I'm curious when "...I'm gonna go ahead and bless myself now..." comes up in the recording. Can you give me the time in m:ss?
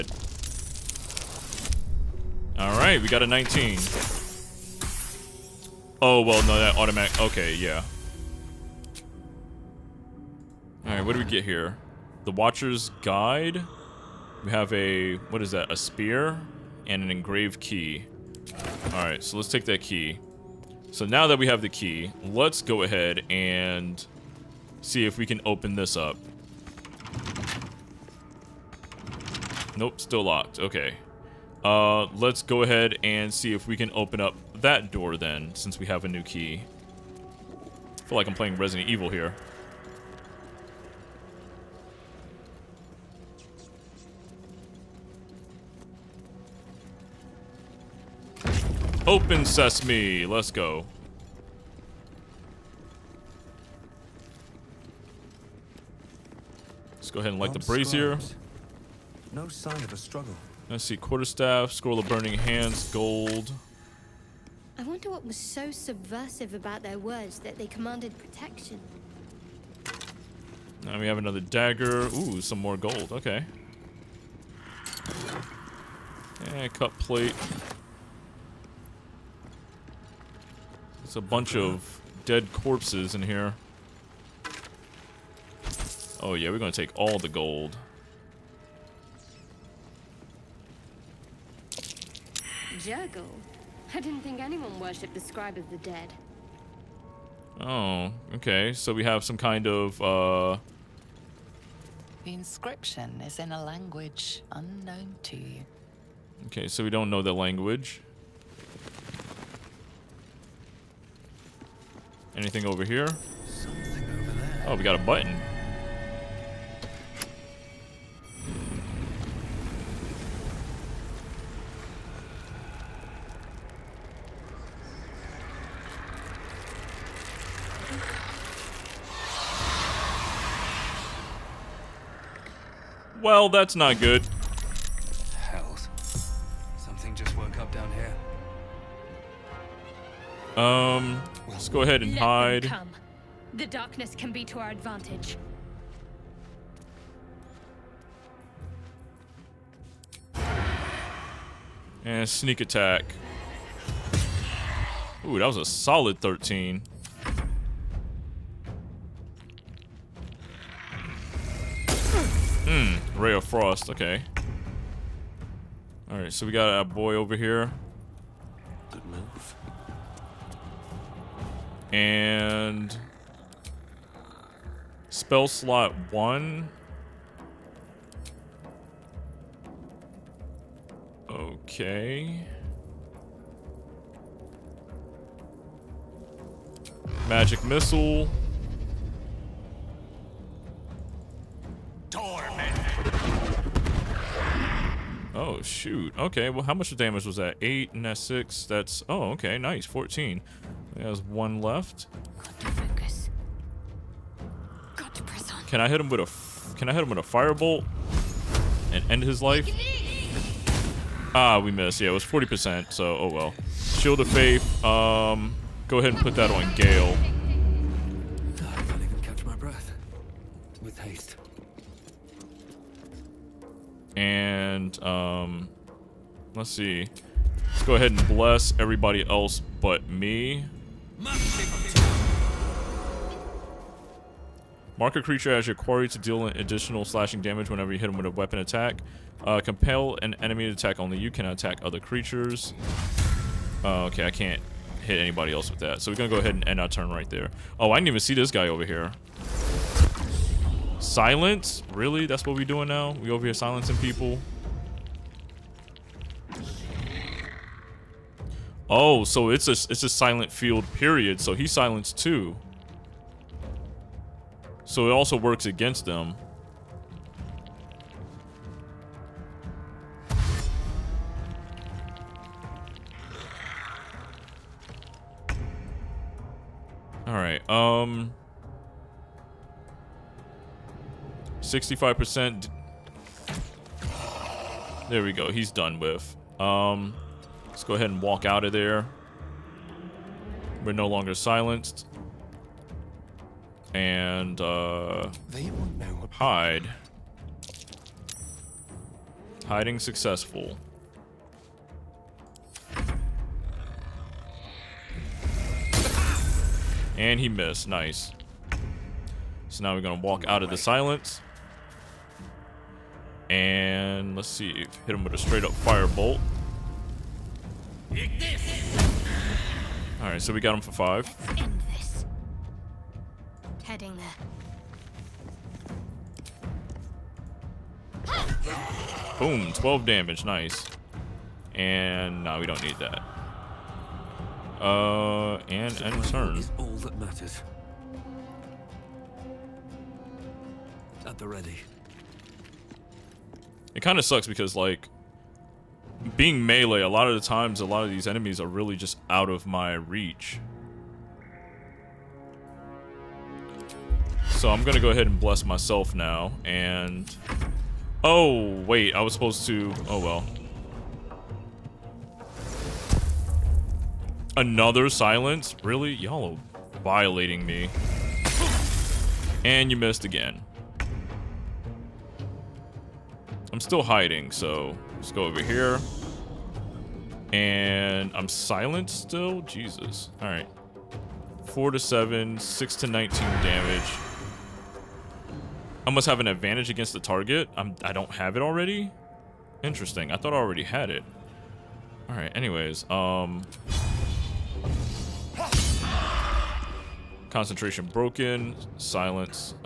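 5:54.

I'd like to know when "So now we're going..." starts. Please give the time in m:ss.
5:09.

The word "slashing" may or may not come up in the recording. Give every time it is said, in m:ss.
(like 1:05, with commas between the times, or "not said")
3:57.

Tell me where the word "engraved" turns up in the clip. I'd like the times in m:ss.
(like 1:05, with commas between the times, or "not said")
0:17.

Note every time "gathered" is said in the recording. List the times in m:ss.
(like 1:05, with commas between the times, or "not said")
not said.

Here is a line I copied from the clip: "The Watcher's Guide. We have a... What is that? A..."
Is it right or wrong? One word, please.
right.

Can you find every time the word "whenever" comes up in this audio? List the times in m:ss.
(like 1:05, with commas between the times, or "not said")
3:57.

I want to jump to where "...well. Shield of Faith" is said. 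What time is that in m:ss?
3:33.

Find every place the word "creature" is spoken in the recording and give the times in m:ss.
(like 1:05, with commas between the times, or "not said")
3:55, 4:02.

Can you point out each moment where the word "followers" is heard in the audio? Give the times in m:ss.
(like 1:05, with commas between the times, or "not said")
not said.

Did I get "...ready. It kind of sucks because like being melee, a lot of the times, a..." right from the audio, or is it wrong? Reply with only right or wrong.
right.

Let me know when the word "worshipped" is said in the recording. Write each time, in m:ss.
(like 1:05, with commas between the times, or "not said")
1:34.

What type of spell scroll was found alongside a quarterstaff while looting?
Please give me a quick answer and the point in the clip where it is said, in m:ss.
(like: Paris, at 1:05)
burning hands, at 1:01.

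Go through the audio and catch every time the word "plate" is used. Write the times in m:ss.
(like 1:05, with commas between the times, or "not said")
1:16.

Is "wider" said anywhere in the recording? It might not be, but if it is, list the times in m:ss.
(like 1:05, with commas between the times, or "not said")
not said.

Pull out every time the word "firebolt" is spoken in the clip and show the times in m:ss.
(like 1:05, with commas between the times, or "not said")
3:27, 5:15.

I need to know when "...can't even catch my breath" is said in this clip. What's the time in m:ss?
3:38.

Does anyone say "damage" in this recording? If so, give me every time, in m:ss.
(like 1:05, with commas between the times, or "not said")
3:16, 3:57, 5:30, 6:23.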